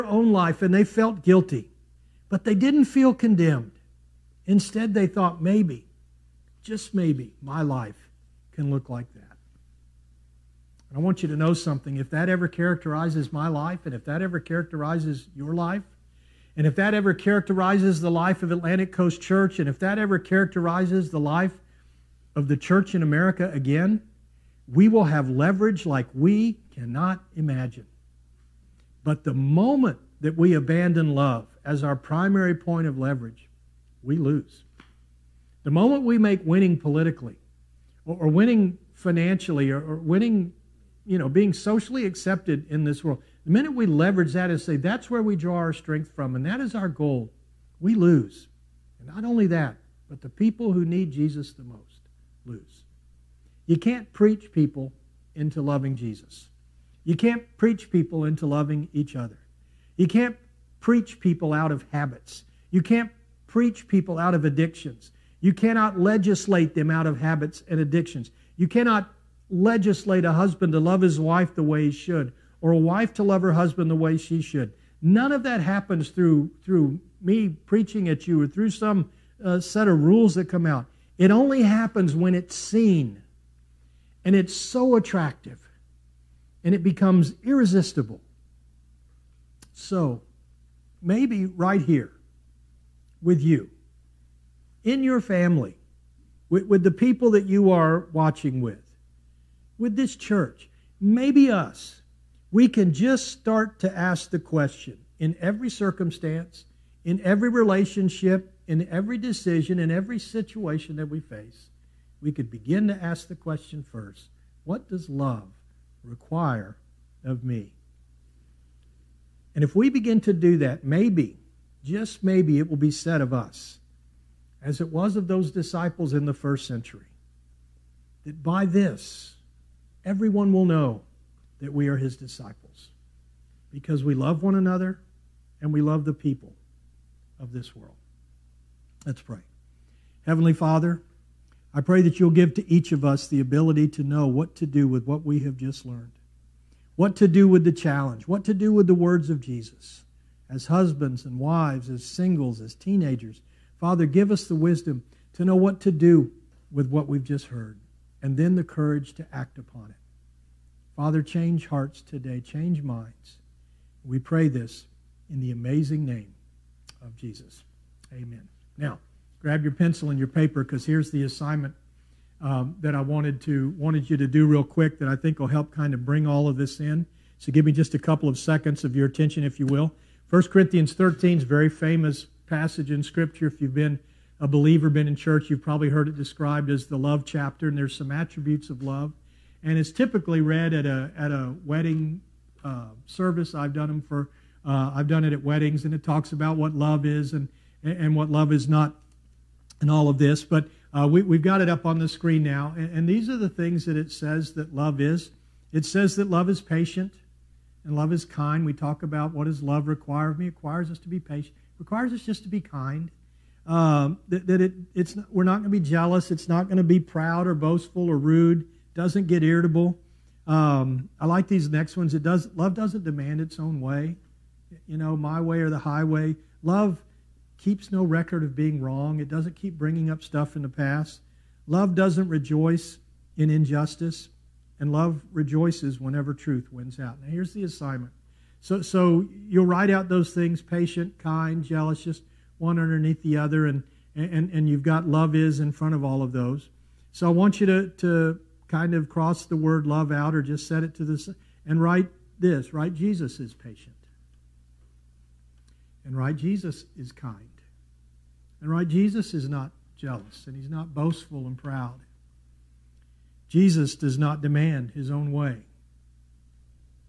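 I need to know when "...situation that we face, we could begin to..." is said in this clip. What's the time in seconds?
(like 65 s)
110 s.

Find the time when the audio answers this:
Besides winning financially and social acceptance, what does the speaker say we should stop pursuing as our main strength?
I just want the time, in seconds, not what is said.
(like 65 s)
36 s.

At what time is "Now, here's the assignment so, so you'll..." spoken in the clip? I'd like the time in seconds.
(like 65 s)
237 s.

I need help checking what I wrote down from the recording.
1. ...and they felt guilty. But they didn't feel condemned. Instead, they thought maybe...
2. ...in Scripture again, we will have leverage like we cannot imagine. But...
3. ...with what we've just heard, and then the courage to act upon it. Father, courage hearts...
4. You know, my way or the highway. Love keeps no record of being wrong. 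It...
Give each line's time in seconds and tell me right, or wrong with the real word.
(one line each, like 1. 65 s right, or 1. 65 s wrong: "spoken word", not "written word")
1. 0 s right
2. 22 s wrong: "America", not "Scripture"
3. 156 s wrong: "change", not "courage"
4. 224 s right.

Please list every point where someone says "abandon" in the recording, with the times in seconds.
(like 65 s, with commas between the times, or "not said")
30 s.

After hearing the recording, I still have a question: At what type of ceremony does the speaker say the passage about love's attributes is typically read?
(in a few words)
A wedding.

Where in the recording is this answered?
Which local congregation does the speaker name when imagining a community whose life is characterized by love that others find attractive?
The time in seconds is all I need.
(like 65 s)
18 s.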